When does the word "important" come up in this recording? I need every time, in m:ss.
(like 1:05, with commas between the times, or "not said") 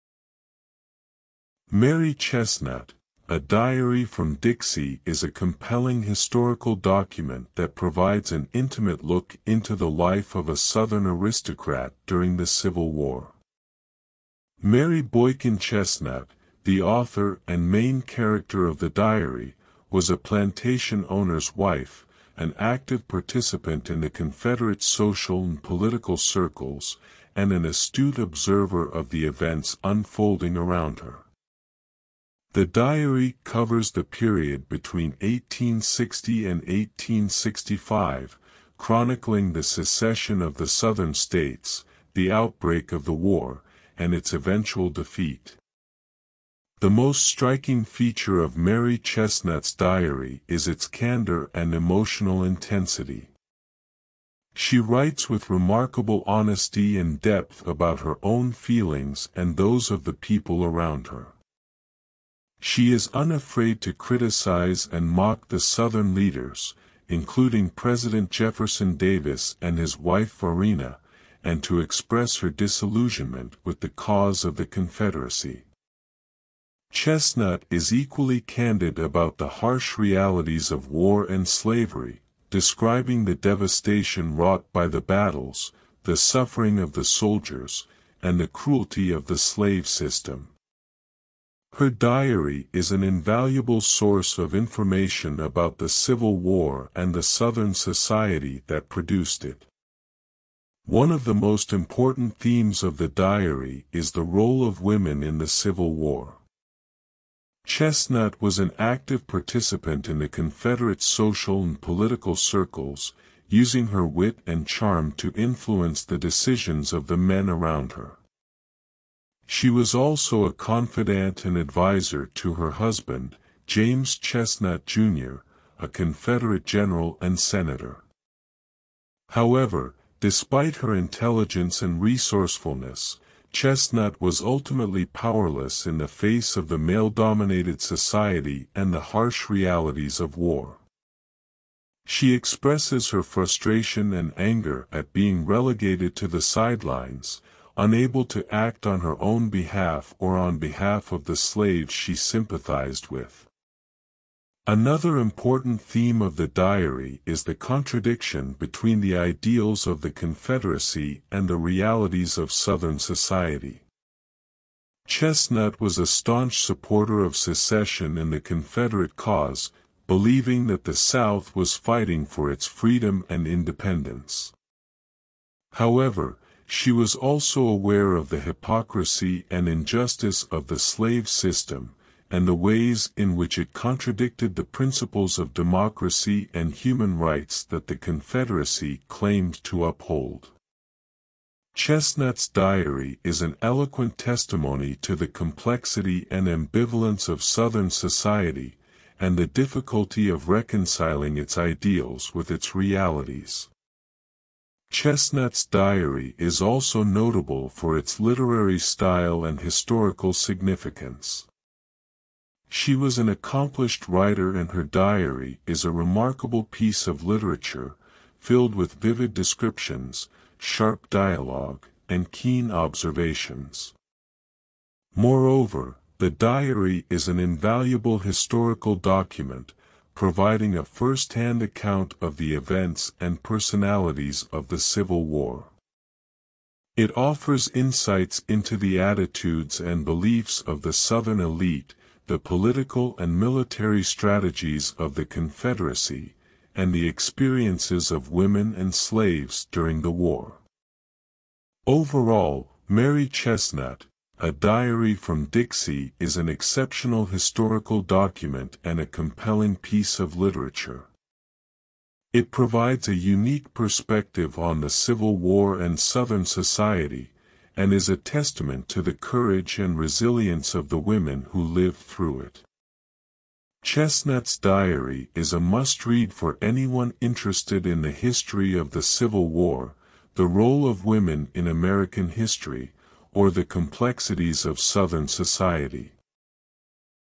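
1:41, 2:35.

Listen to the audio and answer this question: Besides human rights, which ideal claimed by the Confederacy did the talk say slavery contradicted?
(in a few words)
Democracy.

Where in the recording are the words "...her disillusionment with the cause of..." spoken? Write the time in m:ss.
1:12.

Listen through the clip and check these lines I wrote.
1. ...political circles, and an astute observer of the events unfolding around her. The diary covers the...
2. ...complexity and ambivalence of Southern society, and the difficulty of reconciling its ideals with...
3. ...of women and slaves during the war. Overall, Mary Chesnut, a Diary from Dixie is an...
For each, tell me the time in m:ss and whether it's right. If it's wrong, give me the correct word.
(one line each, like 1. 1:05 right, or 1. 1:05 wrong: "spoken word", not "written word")
1. 0:25 right
2. 3:15 right
3. 4:08 right.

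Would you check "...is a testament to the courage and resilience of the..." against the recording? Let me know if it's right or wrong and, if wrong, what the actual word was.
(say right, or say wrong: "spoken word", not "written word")
right.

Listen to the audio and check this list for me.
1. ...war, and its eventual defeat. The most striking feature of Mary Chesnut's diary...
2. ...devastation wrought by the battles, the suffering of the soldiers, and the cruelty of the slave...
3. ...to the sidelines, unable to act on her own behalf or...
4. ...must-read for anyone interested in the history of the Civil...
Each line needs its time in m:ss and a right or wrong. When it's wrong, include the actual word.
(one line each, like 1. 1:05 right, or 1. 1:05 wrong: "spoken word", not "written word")
1. 0:43 right
2. 1:23 right
3. 2:26 right
4. 4:35 right.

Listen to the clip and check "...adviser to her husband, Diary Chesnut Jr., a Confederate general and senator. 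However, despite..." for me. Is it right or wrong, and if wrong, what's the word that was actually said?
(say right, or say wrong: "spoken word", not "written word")
wrong: "James", not "Diary".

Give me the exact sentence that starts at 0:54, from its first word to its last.
She writes with remarkable honesty and depth about her own feelings and those of the people around her.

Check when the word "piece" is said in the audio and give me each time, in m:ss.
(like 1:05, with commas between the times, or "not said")
3:36, 4:19.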